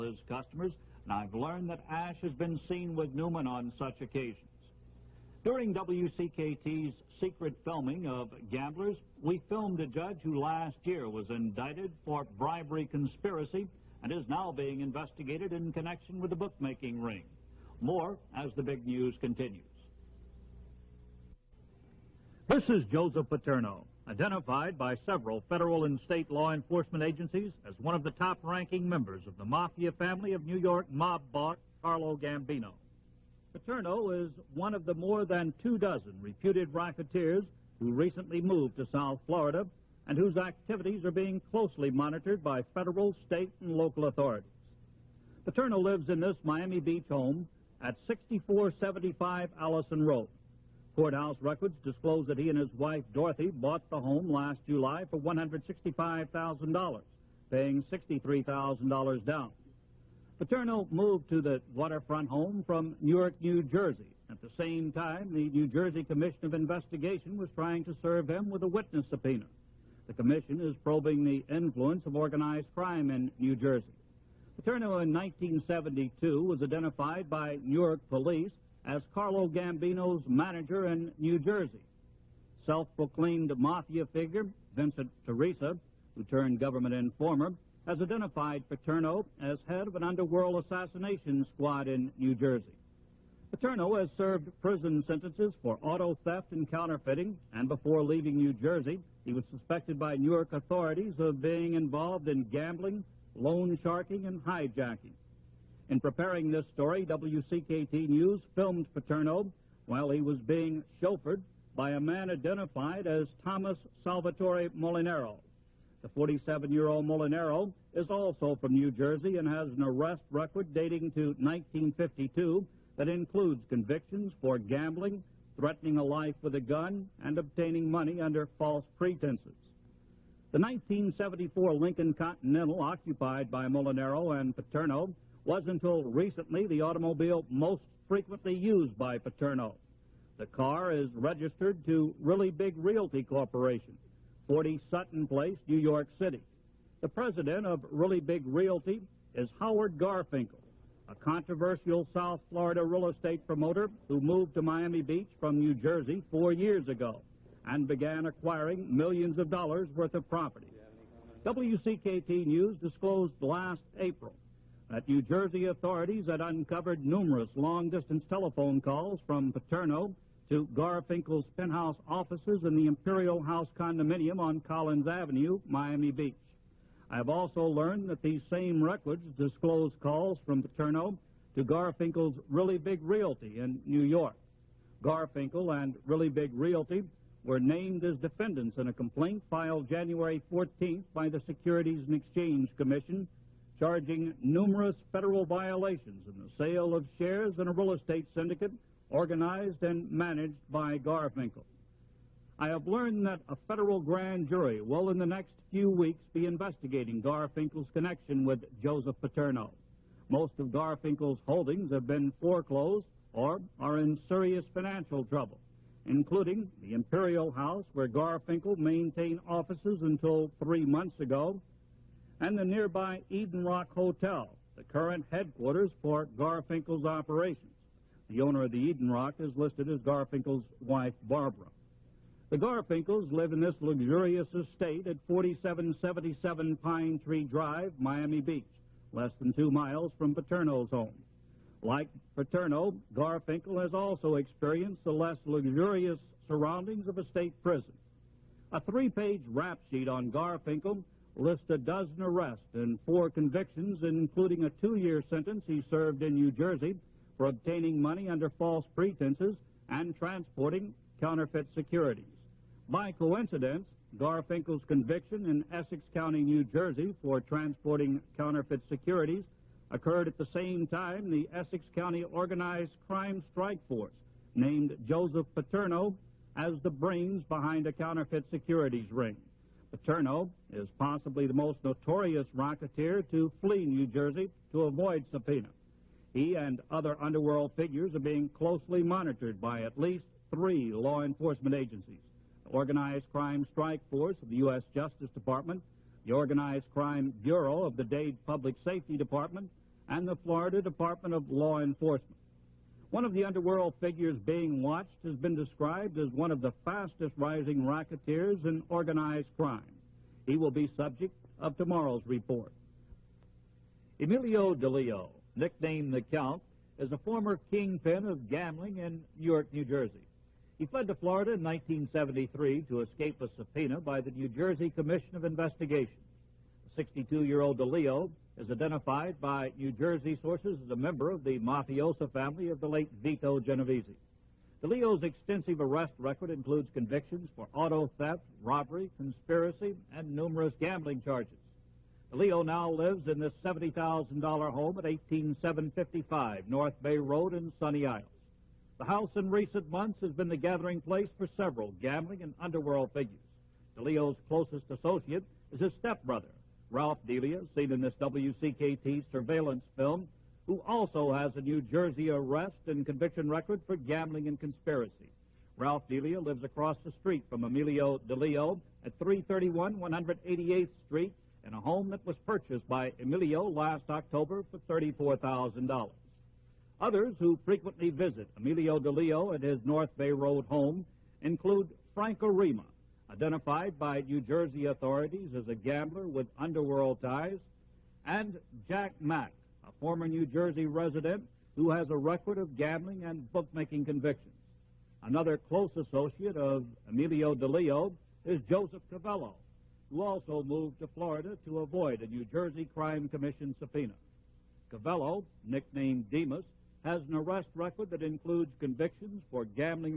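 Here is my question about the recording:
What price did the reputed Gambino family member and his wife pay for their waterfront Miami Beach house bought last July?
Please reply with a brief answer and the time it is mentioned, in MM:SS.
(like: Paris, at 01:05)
$165,000, at 00:55.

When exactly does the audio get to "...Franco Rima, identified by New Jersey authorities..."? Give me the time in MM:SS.
06:22.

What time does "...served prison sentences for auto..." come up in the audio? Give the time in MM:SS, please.
01:34.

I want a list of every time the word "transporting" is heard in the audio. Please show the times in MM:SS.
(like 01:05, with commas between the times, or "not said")
04:20, 04:27.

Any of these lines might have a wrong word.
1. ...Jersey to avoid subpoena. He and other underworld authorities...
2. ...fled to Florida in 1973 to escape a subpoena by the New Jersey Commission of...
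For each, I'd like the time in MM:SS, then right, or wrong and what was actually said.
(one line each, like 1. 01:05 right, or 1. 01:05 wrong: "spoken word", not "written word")
1. 04:44 wrong: "figures", not "authorities"
2. 05:20 right.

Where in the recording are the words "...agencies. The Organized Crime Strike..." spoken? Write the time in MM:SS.
04:51.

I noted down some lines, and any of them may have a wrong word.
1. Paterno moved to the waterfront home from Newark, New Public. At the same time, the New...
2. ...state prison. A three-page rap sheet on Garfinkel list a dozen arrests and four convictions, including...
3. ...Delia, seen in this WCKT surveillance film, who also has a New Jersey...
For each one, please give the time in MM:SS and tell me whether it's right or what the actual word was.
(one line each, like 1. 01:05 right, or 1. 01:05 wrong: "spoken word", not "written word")
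1. 01:00 wrong: "Jersey", not "Public"
2. 04:07 right
3. 05:57 right.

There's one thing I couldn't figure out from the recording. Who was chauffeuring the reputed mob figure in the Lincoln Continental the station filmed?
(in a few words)
Thomas Salvatore Molinero.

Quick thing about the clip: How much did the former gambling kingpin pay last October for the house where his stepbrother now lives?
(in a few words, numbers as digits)
$34,000.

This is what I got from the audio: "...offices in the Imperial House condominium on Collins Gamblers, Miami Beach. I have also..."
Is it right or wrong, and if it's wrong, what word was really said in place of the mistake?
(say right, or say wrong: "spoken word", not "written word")
wrong: "Avenue", not "Gamblers".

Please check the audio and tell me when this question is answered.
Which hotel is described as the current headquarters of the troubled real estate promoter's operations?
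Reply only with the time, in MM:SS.
03:43.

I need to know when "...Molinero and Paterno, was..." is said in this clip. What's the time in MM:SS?
02:13.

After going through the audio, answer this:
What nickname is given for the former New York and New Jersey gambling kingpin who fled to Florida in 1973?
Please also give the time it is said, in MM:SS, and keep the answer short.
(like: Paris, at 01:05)
the Count, at 05:16.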